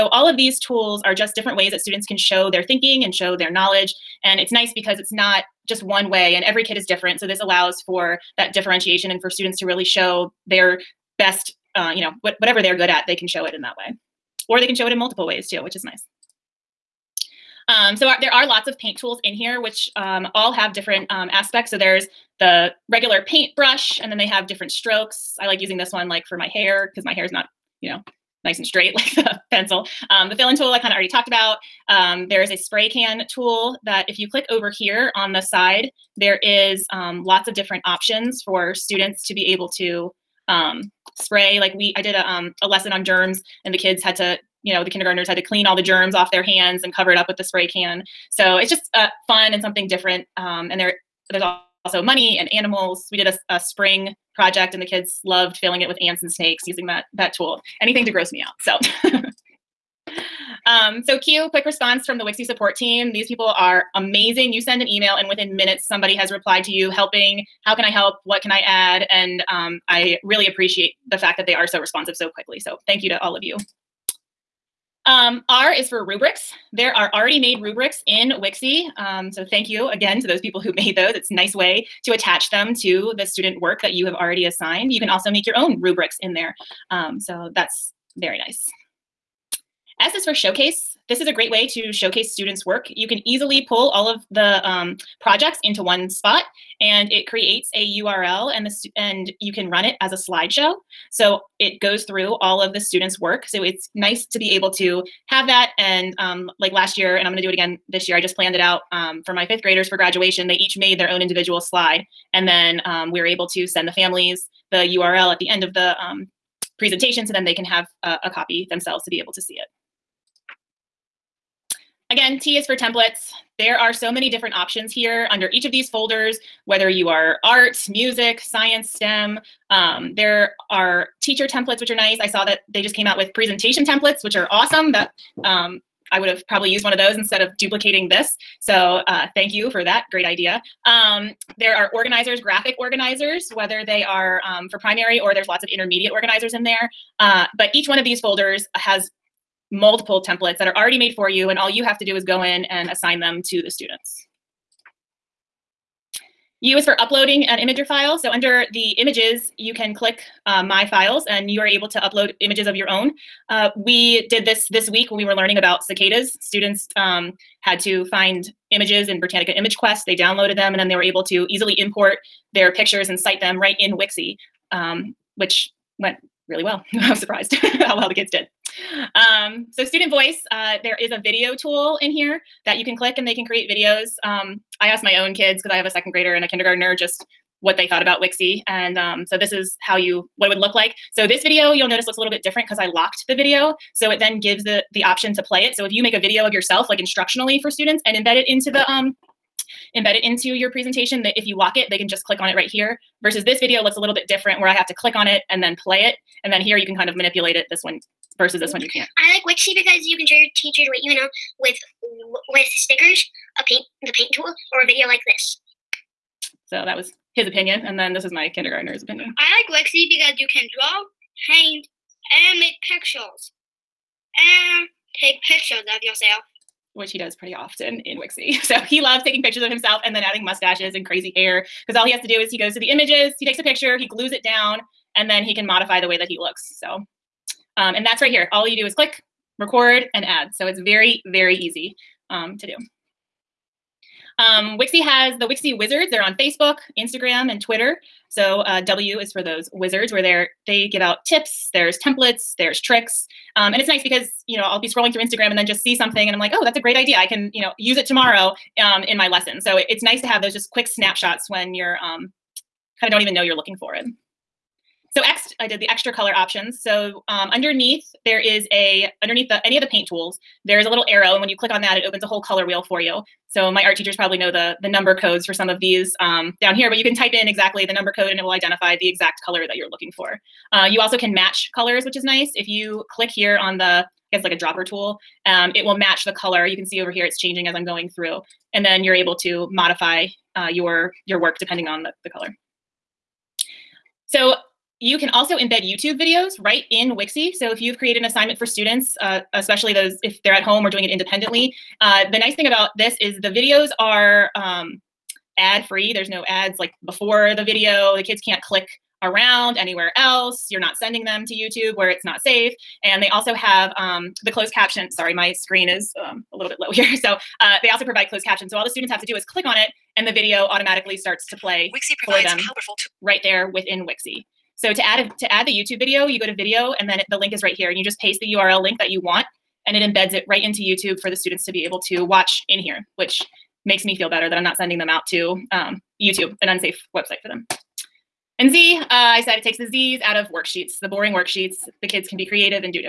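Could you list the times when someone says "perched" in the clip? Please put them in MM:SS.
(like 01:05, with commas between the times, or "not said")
not said.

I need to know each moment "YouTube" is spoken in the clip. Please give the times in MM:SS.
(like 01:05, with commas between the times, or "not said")
04:55, 05:11, 05:25, 05:30, 05:36.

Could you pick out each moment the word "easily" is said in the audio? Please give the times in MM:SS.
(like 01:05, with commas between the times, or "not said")
01:33, 02:51.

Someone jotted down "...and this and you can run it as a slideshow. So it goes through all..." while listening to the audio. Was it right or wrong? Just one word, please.
right.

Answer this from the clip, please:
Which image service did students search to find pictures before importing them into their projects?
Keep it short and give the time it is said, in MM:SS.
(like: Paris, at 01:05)
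Britannica Image Quest, at 02:49.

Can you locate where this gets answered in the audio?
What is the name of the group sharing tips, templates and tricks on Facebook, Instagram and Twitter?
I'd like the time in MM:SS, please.
04:05.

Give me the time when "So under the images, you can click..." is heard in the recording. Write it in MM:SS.
02:38.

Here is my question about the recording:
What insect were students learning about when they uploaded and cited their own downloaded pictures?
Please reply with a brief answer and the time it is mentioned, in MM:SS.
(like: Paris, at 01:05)
cicadas, at 02:45.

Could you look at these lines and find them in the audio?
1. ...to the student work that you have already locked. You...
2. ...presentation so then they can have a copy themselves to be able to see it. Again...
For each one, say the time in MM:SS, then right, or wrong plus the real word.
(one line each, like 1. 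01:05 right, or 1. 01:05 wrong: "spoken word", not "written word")
1. 01:22 wrong: "assigned", not "locked"
2. 01:56 right.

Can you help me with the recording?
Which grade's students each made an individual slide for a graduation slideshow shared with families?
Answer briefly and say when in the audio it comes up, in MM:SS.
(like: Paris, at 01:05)
fifth graders, at 01:49.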